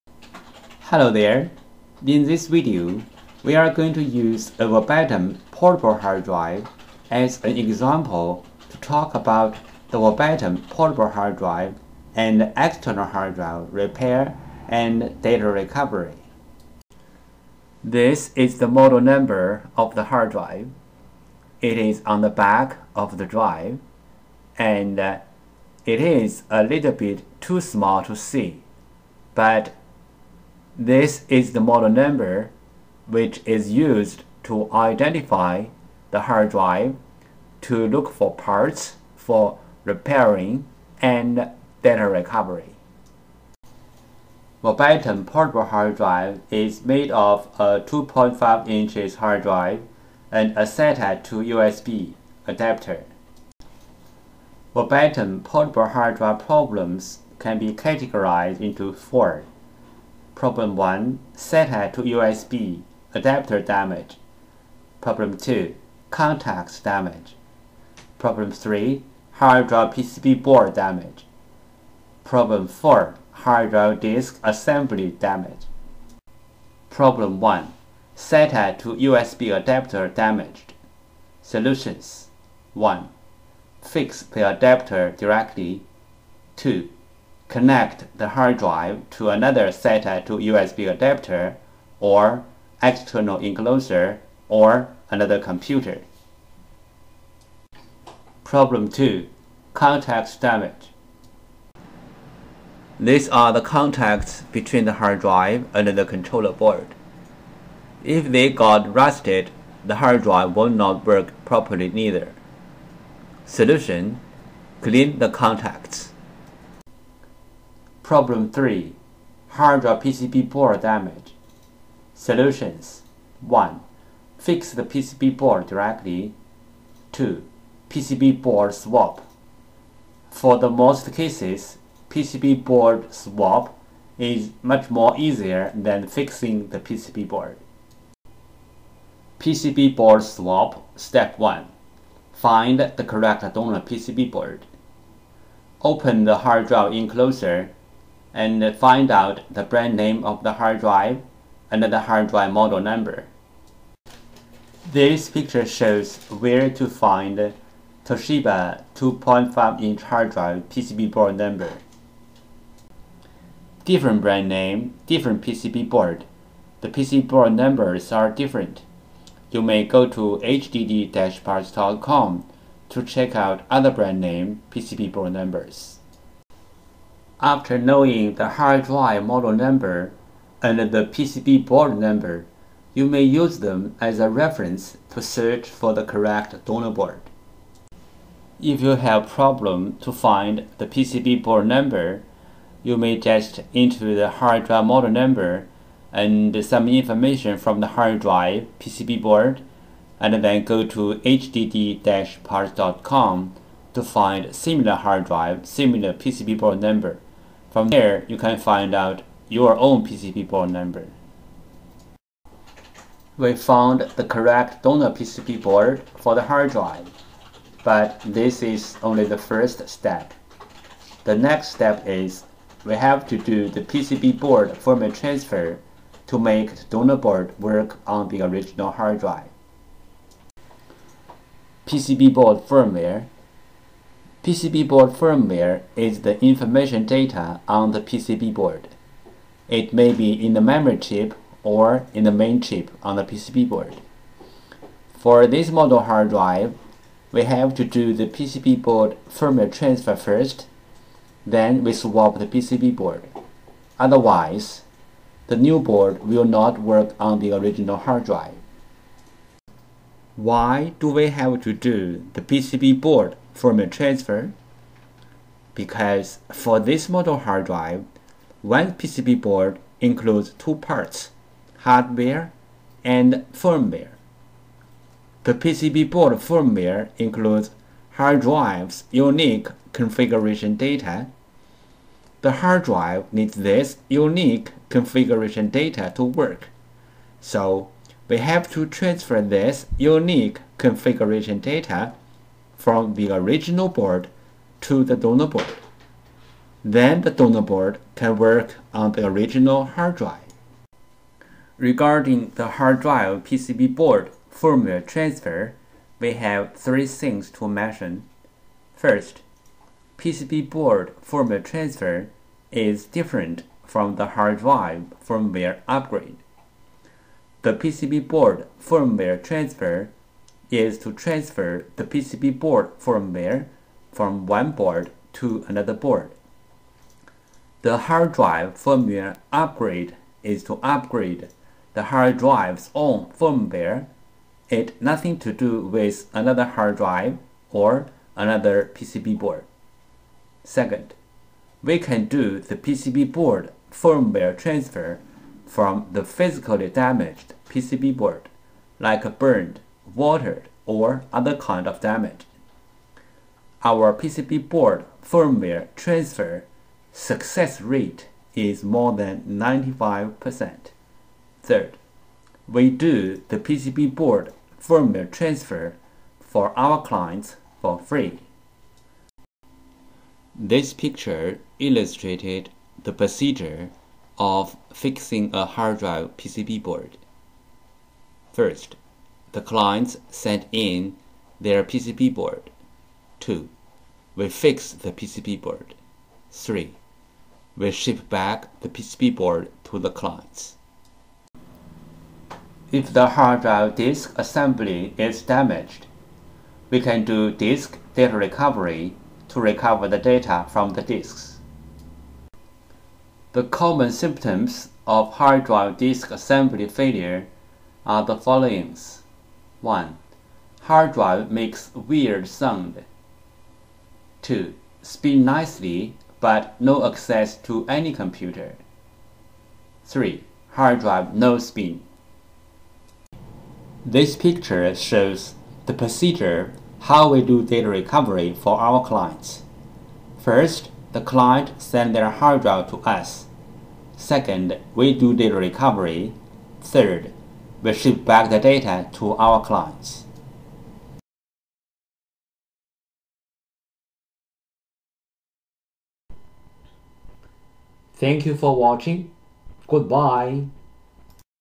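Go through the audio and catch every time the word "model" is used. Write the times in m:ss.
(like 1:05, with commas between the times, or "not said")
0:18, 0:31, 2:32, 2:59, 3:14, 4:05, 4:27.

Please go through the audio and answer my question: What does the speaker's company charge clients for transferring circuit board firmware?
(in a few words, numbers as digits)
free.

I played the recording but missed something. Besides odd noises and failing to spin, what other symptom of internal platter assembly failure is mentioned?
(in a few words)
no access to any computer.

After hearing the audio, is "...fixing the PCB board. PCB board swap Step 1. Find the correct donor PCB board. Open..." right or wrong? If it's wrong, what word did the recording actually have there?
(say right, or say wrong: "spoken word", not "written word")
right.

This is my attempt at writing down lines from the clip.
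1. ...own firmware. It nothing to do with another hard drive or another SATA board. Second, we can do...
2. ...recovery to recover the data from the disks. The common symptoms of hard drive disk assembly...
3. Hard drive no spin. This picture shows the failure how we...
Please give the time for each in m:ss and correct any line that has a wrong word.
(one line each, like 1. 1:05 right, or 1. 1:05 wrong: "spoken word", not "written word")
1. 5:32 wrong: "PCB", not "SATA"
2. 6:38 right
3. 7:00 wrong: "procedure", not "failure".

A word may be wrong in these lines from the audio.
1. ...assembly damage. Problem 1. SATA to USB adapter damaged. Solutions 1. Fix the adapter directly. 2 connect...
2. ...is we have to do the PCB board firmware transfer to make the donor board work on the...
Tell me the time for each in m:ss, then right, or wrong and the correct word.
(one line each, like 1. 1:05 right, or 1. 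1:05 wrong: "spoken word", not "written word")
1. 1:14 right
2. 3:42 right.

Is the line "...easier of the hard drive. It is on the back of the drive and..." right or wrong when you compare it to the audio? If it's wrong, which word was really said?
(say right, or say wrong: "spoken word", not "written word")
wrong: "number", not "easier".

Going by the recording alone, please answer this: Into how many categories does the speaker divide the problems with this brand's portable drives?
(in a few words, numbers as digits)
4.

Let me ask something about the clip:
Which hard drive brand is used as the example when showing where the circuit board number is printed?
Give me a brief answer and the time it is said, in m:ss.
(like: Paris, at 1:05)
Toshiba, at 2:38.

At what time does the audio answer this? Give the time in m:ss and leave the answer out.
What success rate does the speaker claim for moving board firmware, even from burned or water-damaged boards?
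5:58.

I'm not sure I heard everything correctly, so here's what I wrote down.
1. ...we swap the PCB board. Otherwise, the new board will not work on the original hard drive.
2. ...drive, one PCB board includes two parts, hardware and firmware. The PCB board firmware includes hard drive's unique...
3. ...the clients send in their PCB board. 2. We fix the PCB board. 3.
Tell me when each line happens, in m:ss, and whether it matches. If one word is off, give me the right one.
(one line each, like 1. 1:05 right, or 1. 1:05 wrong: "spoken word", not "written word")
1. 4:11 right
2. 4:27 right
3. 6:19 right.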